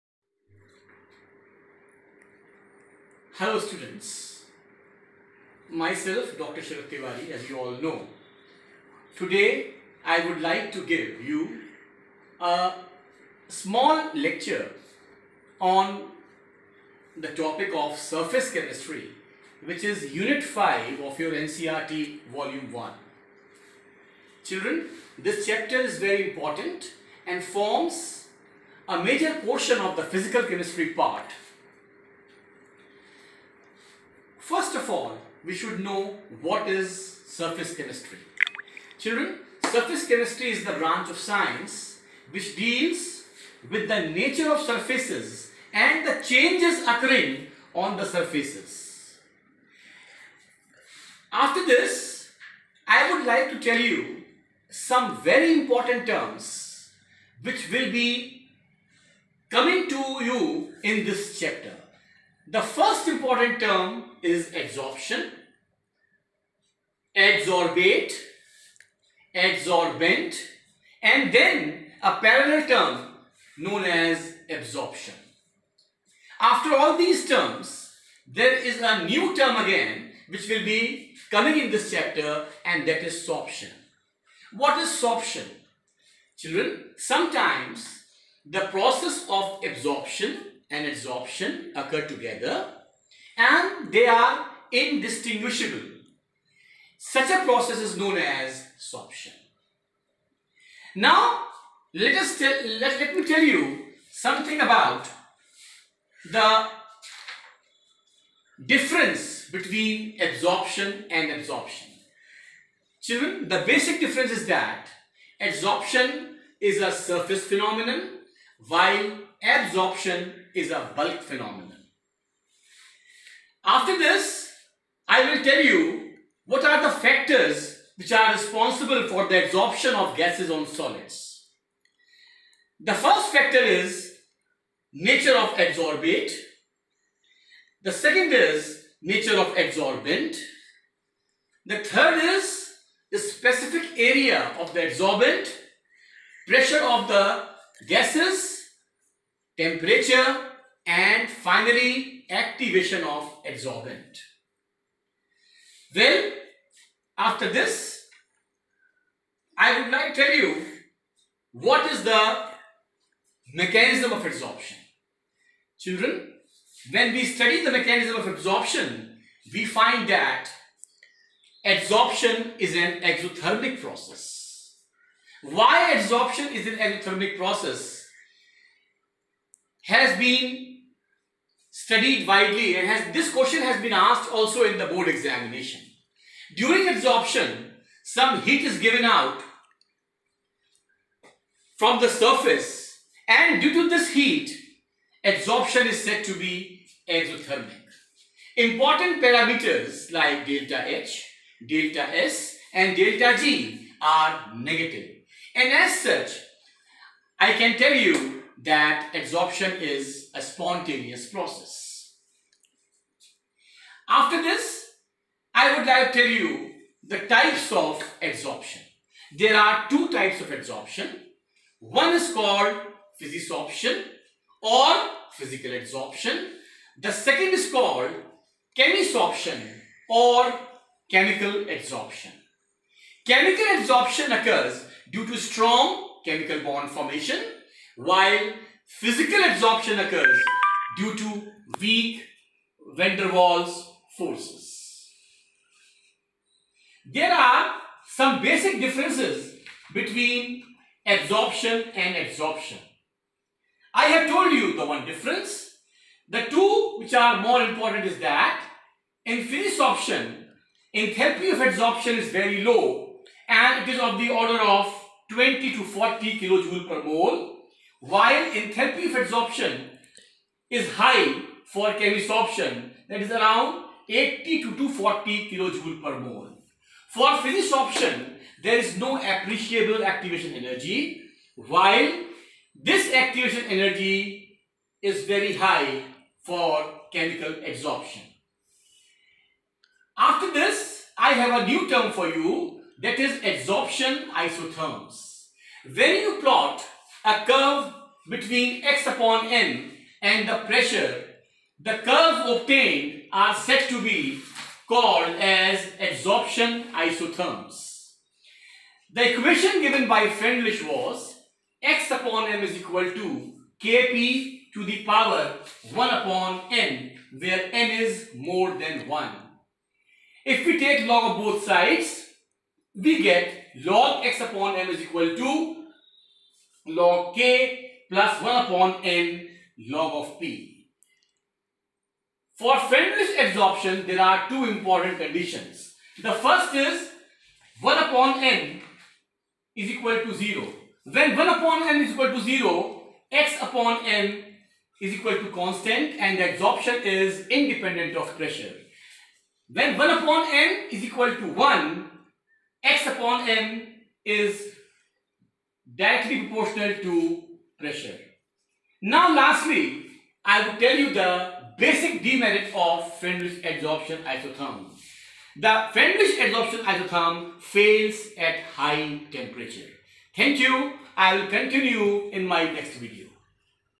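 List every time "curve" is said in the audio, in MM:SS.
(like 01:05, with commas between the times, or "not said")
04:57, 05:02.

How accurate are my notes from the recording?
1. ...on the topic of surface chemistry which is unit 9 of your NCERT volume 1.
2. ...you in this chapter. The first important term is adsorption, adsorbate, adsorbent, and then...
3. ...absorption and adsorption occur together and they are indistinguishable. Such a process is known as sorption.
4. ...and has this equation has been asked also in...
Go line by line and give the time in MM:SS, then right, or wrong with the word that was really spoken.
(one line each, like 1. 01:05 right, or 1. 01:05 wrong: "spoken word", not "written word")
1. 00:15 wrong: "5", not "9"
2. 01:00 right
3. 01:29 right
4. 03:02 wrong: "question", not "equation".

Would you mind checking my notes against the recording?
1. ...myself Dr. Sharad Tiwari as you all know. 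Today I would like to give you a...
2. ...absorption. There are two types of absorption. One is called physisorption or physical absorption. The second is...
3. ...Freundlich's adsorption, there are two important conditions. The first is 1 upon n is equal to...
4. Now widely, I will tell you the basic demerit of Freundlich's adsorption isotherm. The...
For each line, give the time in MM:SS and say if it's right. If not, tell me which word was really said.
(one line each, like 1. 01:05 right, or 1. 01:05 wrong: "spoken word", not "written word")
1. 00:05 right
2. 03:38 right
3. 05:32 right
4. 05:59 wrong: "lastly", not "widely".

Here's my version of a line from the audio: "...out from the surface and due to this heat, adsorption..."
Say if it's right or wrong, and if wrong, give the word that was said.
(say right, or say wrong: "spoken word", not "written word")
right.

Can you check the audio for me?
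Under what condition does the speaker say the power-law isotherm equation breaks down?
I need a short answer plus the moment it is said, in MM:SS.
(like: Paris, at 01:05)
high temperature, at 06:08.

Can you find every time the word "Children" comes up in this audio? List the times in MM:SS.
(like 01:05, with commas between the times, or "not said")
00:24, 00:38, 01:26, 01:53, 02:45.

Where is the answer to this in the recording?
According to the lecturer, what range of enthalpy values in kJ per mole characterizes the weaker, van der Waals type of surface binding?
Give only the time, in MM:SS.
04:25.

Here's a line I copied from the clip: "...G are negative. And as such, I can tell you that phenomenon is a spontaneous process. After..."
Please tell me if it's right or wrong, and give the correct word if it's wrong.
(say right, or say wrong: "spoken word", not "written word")
wrong: "absorption", not "phenomenon".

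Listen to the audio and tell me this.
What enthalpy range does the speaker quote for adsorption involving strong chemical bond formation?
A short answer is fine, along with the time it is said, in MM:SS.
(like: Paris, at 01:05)
80 to 240 kJ/mol, at 04:34.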